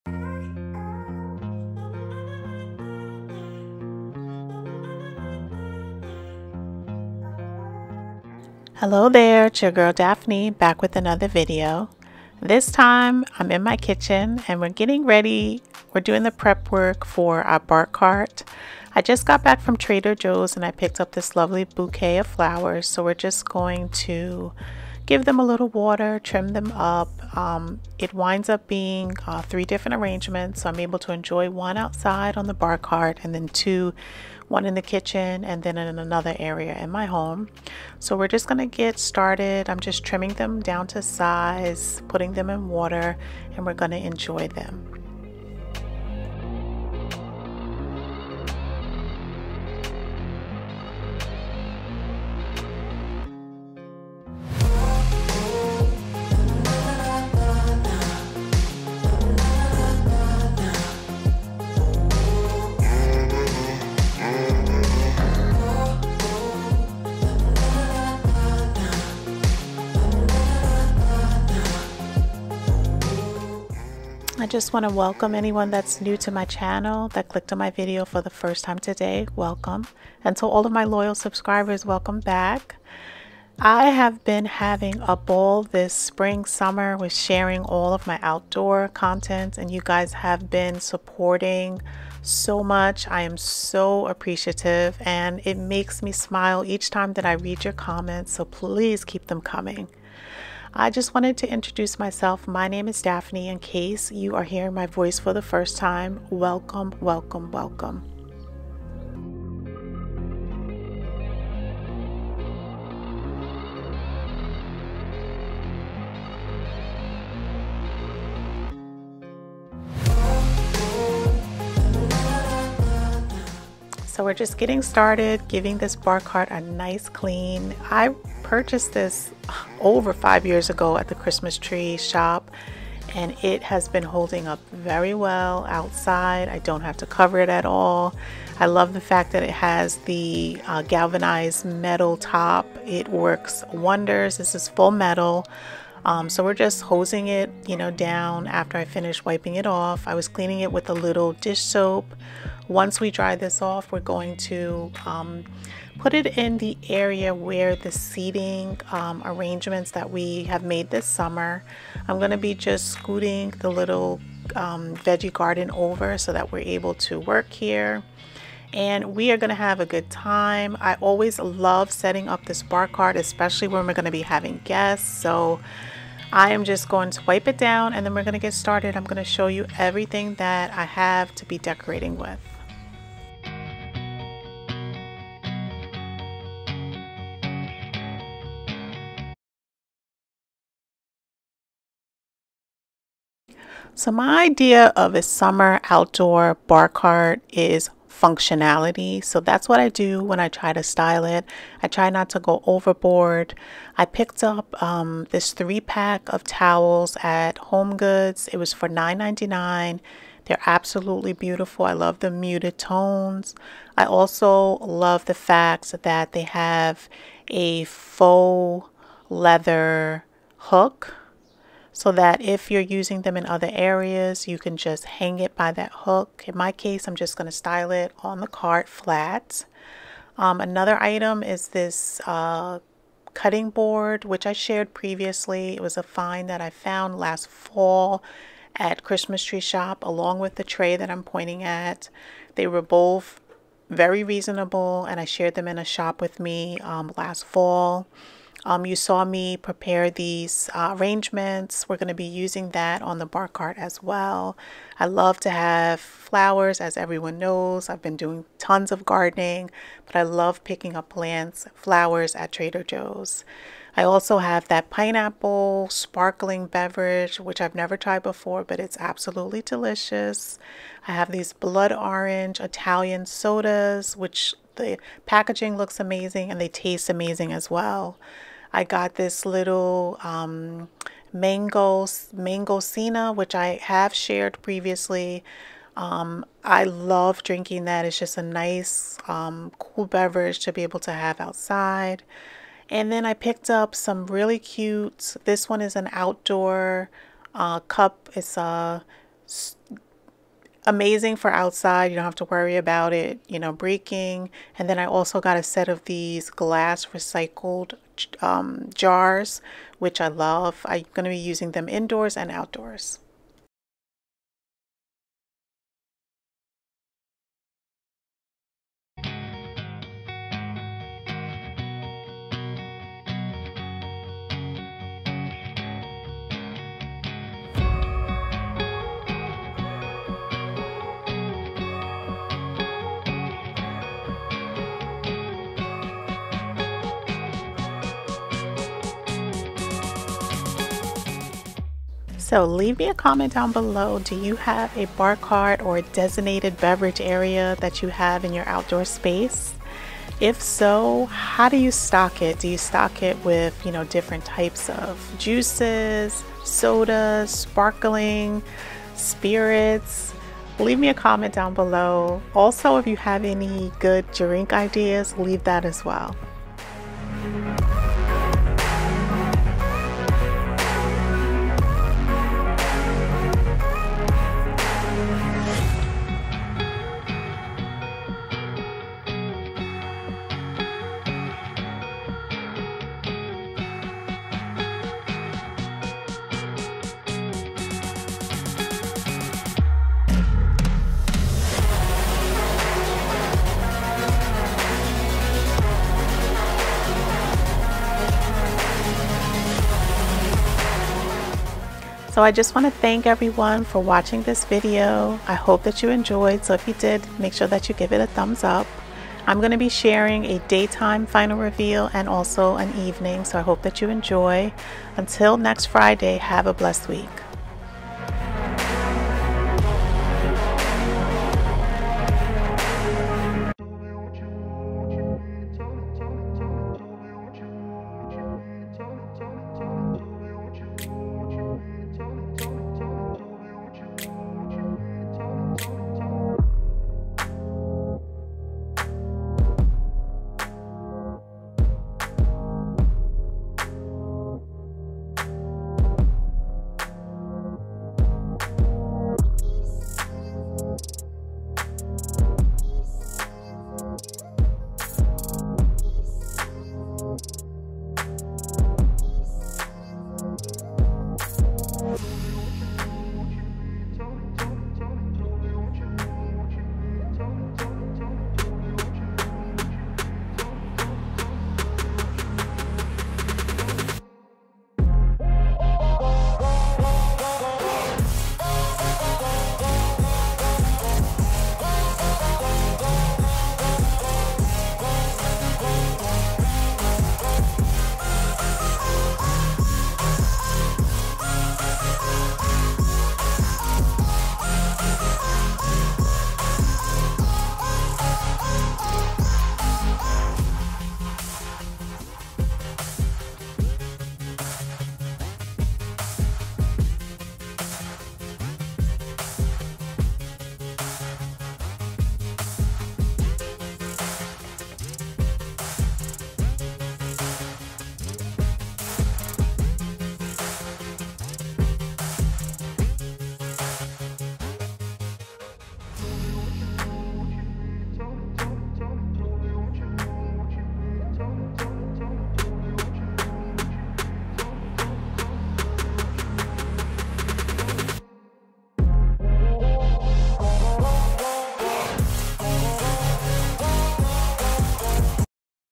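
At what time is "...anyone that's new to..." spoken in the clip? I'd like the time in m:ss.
1:15.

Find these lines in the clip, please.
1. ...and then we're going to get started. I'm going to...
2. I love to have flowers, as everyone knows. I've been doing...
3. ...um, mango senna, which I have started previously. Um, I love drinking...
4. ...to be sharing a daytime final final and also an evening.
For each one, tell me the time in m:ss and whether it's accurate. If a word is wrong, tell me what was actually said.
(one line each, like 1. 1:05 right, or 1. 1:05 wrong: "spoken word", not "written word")
1. 2:57 right
2. 4:14 right
3. 4:40 wrong: "shared", not "started"
4. 6:49 wrong: "reveal", not "final".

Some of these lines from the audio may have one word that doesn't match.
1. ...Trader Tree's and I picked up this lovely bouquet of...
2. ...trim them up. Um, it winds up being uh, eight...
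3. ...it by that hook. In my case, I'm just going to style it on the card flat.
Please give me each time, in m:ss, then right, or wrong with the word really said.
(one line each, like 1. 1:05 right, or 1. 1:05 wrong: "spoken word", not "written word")
1. 0:19 wrong: "Joe", not "Tree"
2. 0:26 wrong: "three", not "eight"
3. 3:45 right.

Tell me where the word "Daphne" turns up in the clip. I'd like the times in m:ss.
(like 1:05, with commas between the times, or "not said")
0:09, 1:43.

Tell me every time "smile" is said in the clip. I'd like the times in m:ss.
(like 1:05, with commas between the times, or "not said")
1:36.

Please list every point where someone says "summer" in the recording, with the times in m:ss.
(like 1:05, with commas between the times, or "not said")
1:26, 2:41, 3:15.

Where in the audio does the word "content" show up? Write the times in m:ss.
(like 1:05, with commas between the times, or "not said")
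1:28.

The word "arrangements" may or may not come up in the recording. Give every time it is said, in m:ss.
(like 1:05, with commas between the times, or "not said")
0:29, 2:39, 4:10.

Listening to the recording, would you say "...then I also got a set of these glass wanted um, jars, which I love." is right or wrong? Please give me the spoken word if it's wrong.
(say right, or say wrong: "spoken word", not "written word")
wrong: "recycled", not "wanted".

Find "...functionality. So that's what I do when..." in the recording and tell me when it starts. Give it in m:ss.
3:18.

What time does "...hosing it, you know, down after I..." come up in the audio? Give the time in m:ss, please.
2:26.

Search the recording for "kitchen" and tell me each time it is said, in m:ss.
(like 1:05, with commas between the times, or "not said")
0:13, 0:34.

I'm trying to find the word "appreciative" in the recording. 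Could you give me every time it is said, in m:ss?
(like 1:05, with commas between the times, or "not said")
1:34.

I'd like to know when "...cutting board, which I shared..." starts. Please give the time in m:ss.
3:53.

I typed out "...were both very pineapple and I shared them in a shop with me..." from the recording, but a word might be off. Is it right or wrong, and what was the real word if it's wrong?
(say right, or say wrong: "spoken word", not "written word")
wrong: "reasonable", not "pineapple".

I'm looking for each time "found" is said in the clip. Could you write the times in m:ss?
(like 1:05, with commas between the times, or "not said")
3:56.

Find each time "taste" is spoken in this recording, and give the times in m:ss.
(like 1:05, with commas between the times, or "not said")
4:36.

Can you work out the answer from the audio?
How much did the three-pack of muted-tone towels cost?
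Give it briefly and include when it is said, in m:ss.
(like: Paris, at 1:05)
$9.99, at 3:28.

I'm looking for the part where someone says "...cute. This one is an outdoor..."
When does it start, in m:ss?
4:54.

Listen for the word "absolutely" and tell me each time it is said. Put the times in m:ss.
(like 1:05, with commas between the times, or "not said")
3:30, 4:28.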